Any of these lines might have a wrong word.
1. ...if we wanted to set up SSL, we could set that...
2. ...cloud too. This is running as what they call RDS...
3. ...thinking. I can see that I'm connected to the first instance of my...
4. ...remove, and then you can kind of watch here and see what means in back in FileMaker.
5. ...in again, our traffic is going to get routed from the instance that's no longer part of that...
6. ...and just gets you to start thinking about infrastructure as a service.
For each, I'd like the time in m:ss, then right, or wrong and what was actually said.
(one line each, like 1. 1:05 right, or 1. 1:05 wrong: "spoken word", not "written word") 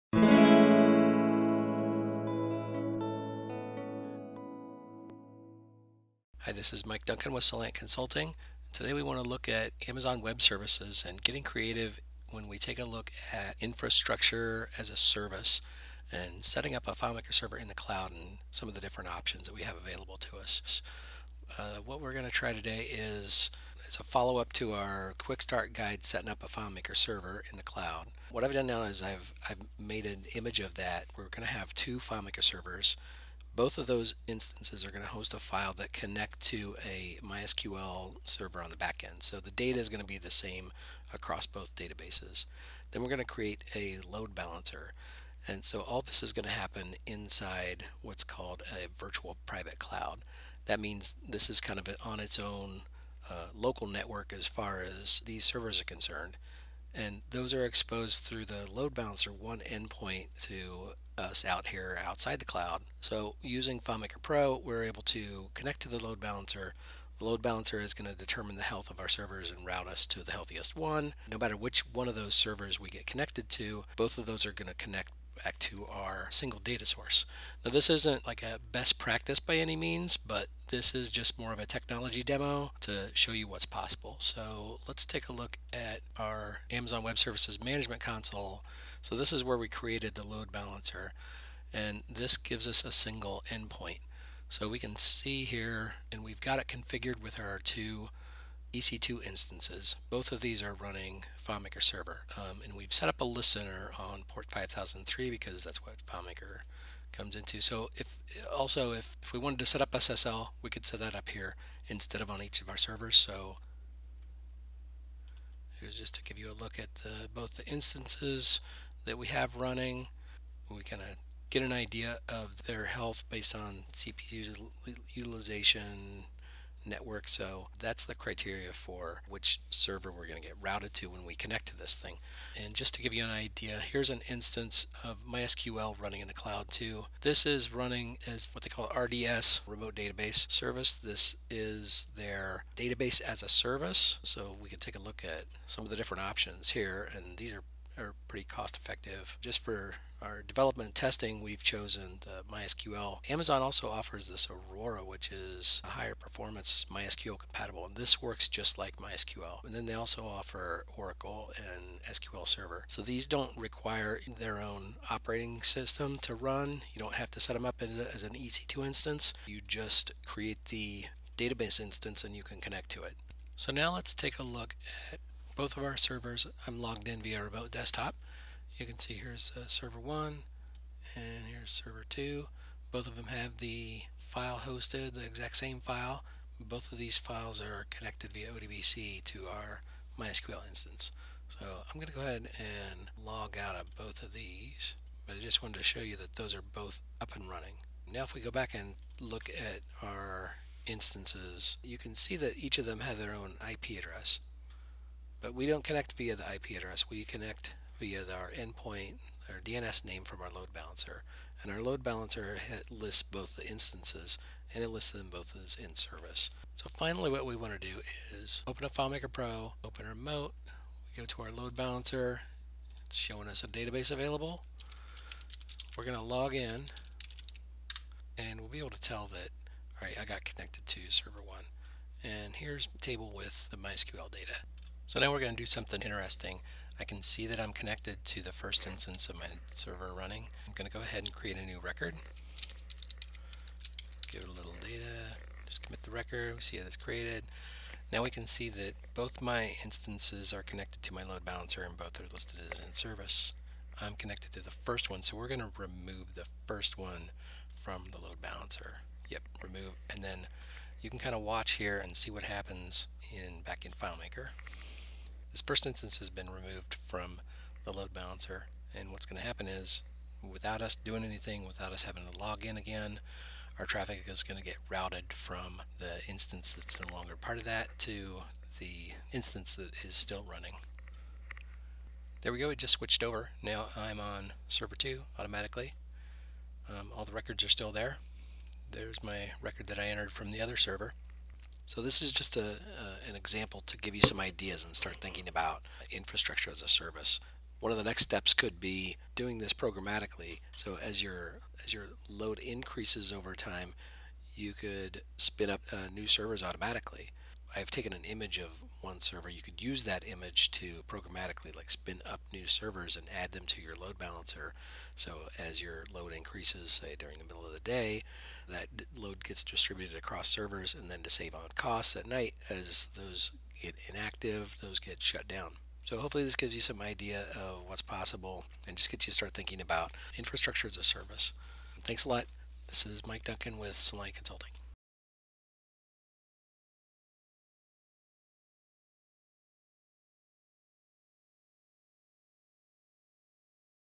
1. 1:49 right
2. 2:16 right
3. 3:56 wrong: "interesting", not "thinking"
4. 4:19 wrong: "happens", not "means"
5. 4:32 right
6. 5:28 right.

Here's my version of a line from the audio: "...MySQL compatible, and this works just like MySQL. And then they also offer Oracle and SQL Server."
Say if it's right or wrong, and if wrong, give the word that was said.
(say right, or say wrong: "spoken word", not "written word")
right.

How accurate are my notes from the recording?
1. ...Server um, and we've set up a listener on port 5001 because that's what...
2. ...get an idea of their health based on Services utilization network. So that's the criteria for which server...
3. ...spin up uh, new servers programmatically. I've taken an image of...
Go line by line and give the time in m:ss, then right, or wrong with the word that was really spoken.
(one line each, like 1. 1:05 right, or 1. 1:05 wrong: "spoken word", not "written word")
1. 1:41 wrong: "5003", not "5001"
2. 2:01 wrong: "CPU", not "Services"
3. 5:05 wrong: "automatically", not "programmatically".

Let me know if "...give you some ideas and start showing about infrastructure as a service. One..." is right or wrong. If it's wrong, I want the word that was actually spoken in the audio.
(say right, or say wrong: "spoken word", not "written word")
wrong: "thinking", not "showing".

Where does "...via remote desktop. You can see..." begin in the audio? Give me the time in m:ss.
2:57.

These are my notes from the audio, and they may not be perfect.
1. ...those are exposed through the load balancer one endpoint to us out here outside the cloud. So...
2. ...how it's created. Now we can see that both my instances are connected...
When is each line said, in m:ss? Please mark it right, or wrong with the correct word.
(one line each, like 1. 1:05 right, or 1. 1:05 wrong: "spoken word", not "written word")
1. 0:57 right
2. 4:06 right.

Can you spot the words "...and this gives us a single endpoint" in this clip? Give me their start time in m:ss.
1:31.